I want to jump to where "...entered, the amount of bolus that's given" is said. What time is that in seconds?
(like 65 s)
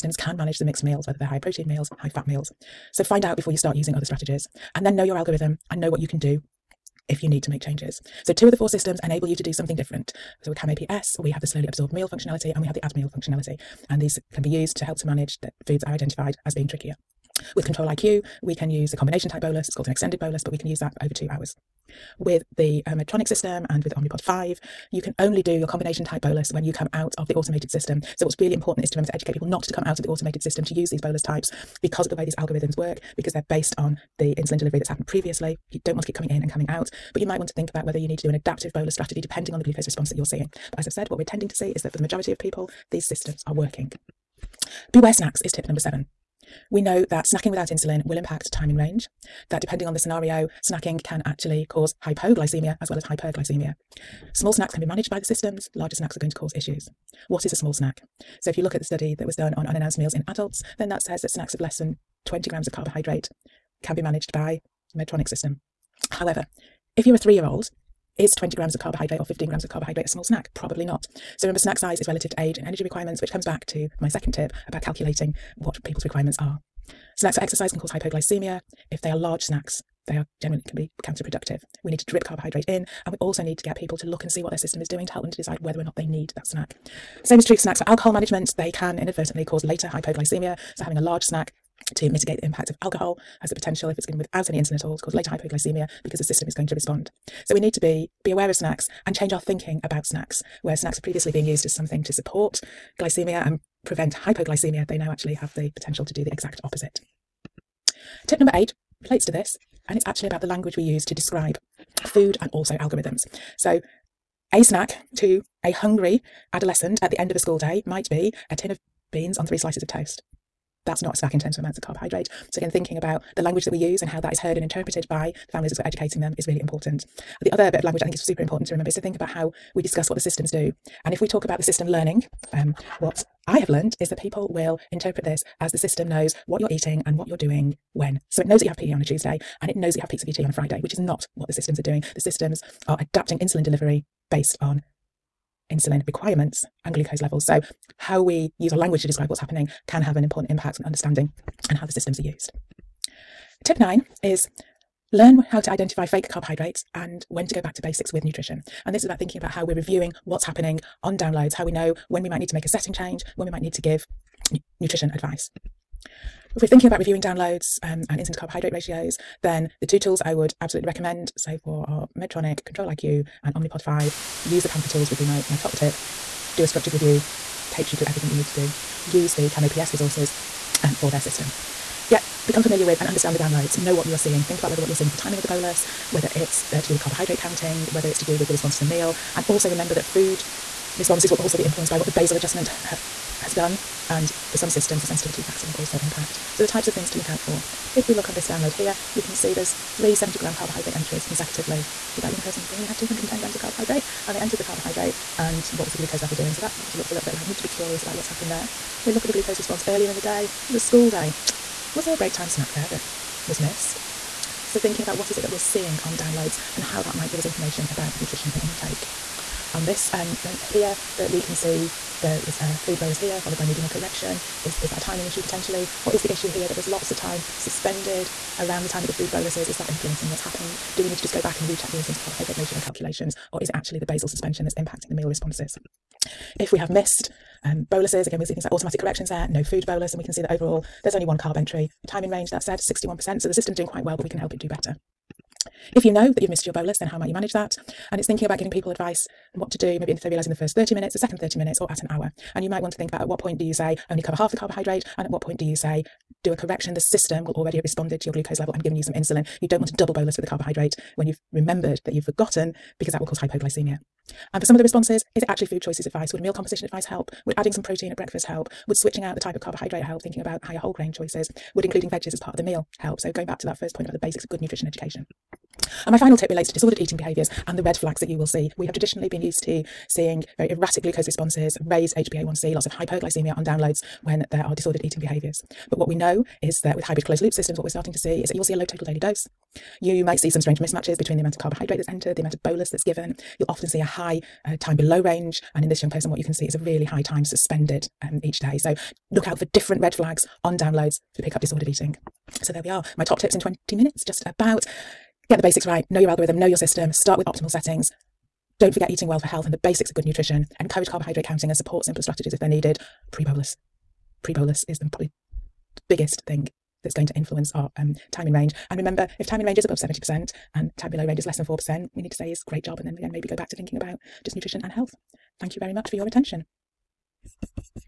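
292 s.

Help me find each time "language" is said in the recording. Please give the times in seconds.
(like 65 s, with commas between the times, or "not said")
110 s, 123 s, 127 s, 148 s.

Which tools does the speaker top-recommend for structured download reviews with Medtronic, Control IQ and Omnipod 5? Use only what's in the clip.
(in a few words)
Panther tools.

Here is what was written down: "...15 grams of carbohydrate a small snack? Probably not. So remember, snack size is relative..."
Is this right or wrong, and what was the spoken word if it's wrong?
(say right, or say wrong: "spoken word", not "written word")
right.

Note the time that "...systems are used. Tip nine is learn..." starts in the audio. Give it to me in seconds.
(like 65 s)
151 s.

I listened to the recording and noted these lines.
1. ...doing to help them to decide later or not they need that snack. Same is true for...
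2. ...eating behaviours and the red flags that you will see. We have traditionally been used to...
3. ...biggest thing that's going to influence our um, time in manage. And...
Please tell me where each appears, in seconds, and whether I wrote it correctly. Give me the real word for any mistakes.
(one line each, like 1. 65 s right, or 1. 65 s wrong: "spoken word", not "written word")
1. 84 s wrong: "whether", not "later"
2. 276 s right
3. 316 s wrong: "range", not "manage".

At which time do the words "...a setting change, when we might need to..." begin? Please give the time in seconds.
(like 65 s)
162 s.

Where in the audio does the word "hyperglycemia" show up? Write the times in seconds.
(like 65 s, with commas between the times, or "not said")
53 s, 282 s.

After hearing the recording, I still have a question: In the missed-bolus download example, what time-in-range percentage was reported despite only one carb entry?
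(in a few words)
61%.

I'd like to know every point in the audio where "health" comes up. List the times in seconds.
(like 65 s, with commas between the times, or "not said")
309 s, 324 s.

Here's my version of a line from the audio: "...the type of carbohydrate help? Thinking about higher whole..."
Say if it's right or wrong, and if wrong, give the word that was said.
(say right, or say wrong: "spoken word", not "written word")
right.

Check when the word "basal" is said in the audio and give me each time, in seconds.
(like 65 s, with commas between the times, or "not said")
192 s, 234 s.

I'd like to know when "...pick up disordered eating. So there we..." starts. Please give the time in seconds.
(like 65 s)
301 s.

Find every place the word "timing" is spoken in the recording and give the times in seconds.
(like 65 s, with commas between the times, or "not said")
185 s, 224 s.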